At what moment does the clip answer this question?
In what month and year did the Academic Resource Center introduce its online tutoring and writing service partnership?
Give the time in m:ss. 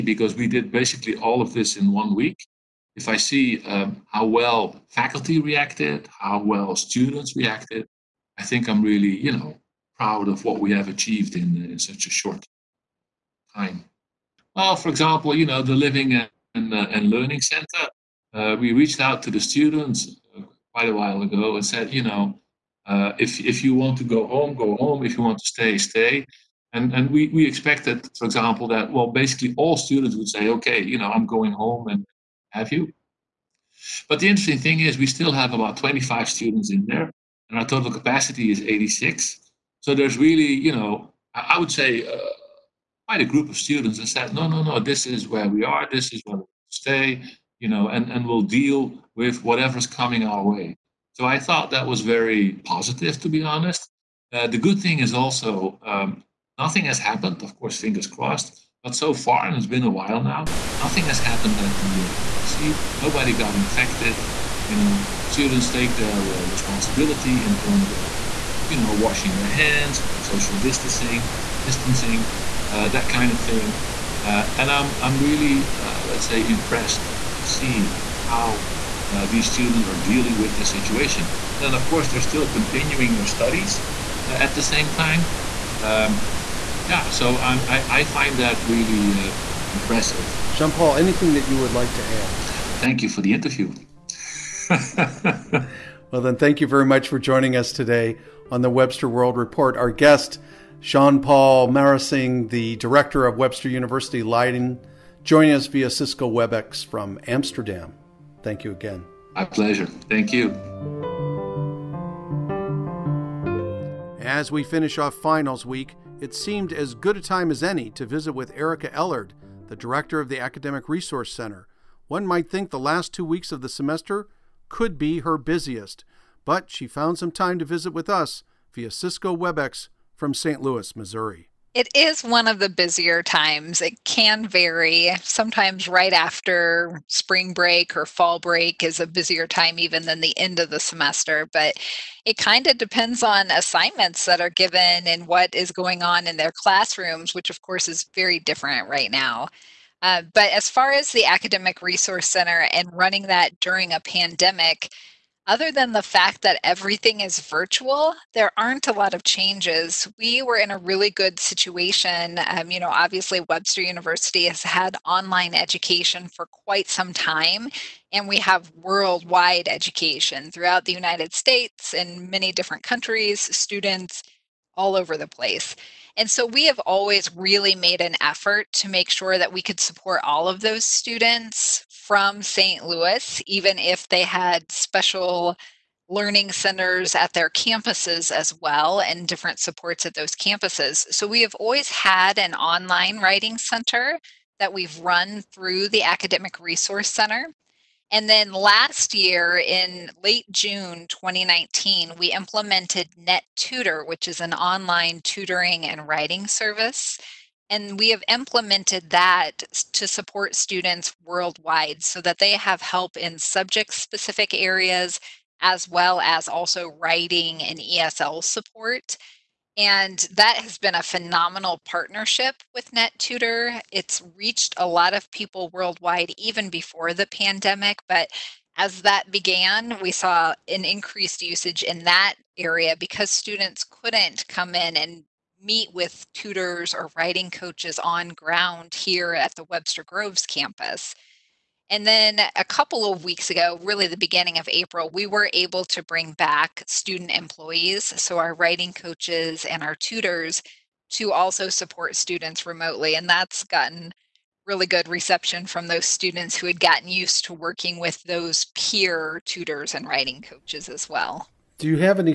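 3:20.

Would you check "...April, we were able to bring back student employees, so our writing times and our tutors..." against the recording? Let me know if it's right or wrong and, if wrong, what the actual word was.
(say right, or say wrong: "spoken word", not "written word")
wrong: "coaches", not "times".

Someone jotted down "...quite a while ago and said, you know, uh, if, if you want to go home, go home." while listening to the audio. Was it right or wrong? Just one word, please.
right.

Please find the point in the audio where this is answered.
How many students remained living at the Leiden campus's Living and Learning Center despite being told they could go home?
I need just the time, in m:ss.
0:35.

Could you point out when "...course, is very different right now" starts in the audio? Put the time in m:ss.
2:27.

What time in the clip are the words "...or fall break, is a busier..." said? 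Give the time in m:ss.
2:17.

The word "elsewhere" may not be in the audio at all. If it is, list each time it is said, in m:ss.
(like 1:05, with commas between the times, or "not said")
not said.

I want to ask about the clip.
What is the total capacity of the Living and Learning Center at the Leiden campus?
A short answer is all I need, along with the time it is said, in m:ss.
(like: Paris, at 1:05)
86, at 0:38.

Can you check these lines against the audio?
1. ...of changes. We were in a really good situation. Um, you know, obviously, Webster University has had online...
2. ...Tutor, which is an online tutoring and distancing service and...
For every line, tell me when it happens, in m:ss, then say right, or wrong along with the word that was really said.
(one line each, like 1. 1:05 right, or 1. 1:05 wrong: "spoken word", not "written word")
1. 2:39 right
2. 3:23 wrong: "writing", not "distancing".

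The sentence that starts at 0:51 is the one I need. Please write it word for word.
So I thought that was very positive, to be honest.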